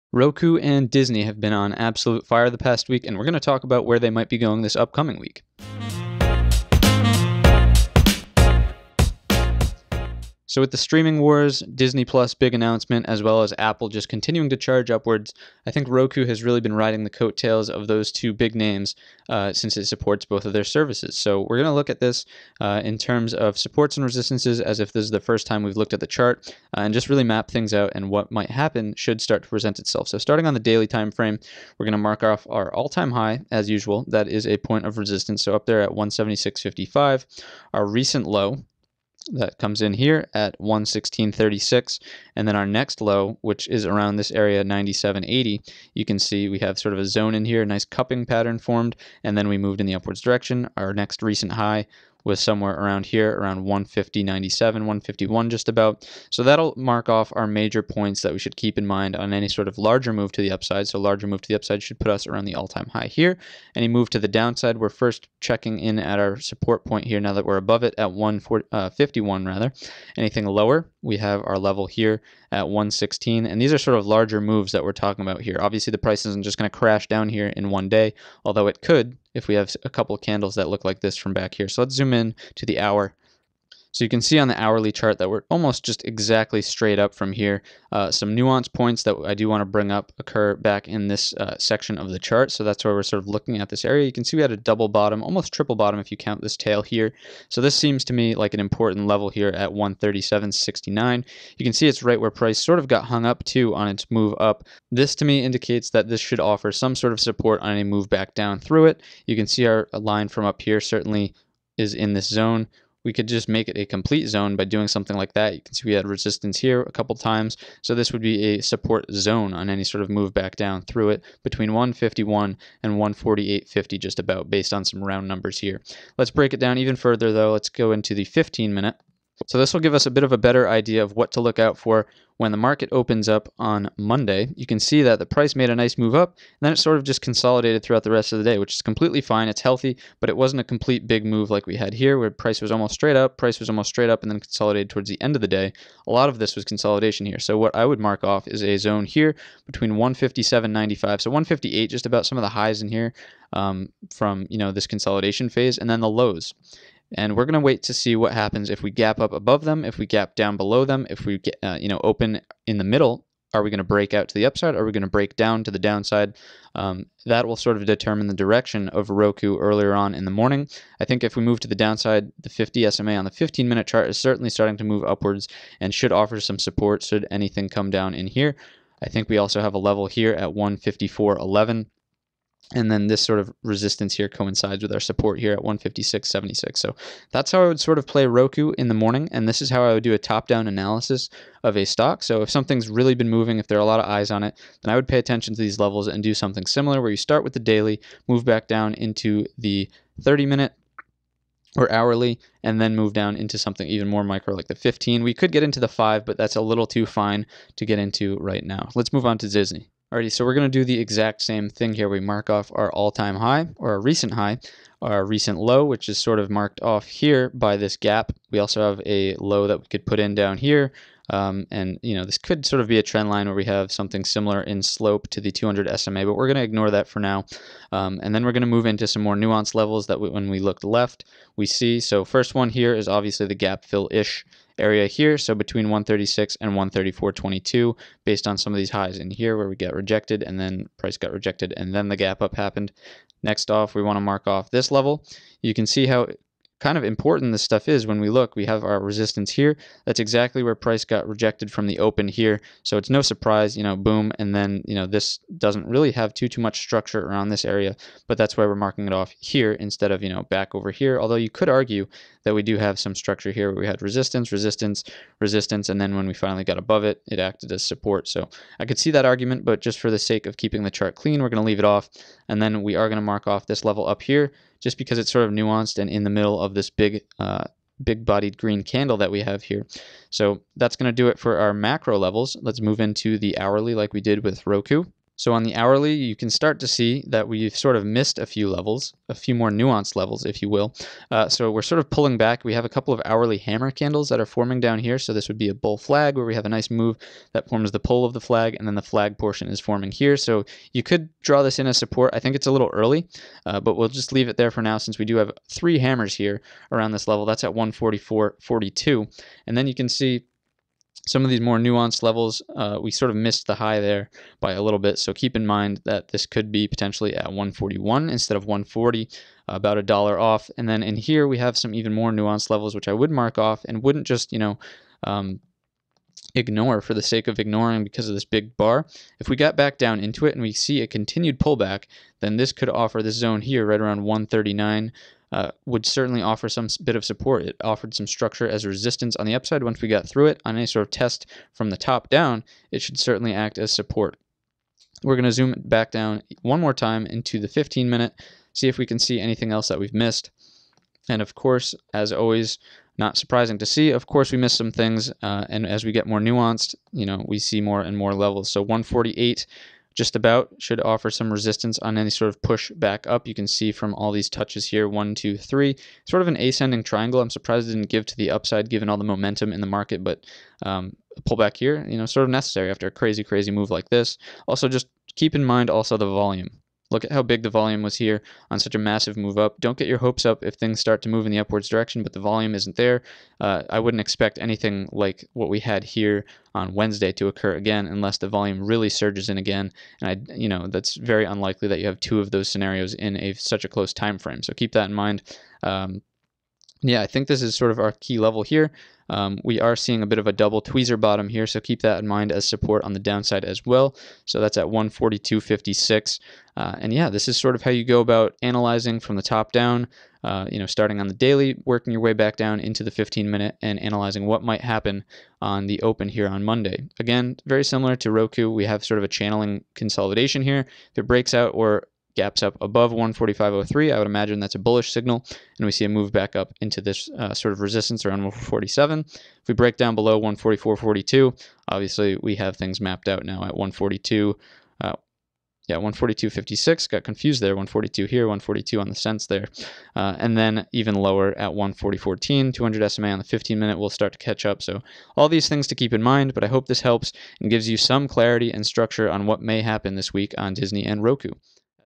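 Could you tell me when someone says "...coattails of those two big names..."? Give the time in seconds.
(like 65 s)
17 s.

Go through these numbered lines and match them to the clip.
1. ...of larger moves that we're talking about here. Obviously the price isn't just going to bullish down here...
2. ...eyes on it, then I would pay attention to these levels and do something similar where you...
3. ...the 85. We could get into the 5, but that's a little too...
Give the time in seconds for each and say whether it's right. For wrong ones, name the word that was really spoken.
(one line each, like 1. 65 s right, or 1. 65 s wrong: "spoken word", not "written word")
1. 73 s wrong: "crash", not "bullish"
2. 194 s right
3. 204 s wrong: "15", not "85".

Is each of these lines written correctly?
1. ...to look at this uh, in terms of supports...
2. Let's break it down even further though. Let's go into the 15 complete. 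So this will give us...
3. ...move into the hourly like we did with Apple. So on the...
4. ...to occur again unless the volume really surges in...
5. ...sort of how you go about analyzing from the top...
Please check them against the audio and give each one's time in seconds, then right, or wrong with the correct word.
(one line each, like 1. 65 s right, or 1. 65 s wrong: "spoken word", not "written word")
1. 21 s right
2. 126 s wrong: "minute", not "complete"
3. 282 s wrong: "Roku", not "Apple"
4. 387 s right
5. 407 s right.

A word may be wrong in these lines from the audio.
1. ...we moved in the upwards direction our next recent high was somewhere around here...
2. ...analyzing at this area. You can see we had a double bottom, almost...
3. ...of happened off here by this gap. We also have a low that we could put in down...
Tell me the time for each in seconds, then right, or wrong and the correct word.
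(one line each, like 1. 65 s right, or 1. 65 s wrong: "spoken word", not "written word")
1. 49 s right
2. 93 s wrong: "looking", not "analyzing"
3. 216 s wrong: "marked", not "happened".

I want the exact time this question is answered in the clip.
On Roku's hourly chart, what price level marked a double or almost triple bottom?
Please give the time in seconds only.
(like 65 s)
99 s.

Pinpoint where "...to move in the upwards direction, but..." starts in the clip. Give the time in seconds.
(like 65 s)
381 s.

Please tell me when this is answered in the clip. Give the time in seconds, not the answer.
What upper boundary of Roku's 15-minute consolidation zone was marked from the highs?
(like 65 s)
149 s.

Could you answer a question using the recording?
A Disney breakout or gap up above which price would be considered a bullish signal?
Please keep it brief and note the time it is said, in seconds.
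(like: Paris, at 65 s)
145.03, at 423 s.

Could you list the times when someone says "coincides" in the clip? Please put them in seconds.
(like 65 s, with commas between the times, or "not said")
184 s.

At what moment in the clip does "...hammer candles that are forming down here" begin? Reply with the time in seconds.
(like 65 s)
293 s.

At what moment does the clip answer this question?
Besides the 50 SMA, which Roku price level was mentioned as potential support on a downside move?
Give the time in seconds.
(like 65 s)
180 s.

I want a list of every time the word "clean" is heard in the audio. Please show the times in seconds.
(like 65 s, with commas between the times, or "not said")
271 s.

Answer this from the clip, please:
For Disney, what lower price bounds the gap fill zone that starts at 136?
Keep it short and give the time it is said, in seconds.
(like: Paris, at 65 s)
134.22, at 236 s.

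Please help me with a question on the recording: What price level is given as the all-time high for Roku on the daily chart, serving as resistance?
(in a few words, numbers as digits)
176.55.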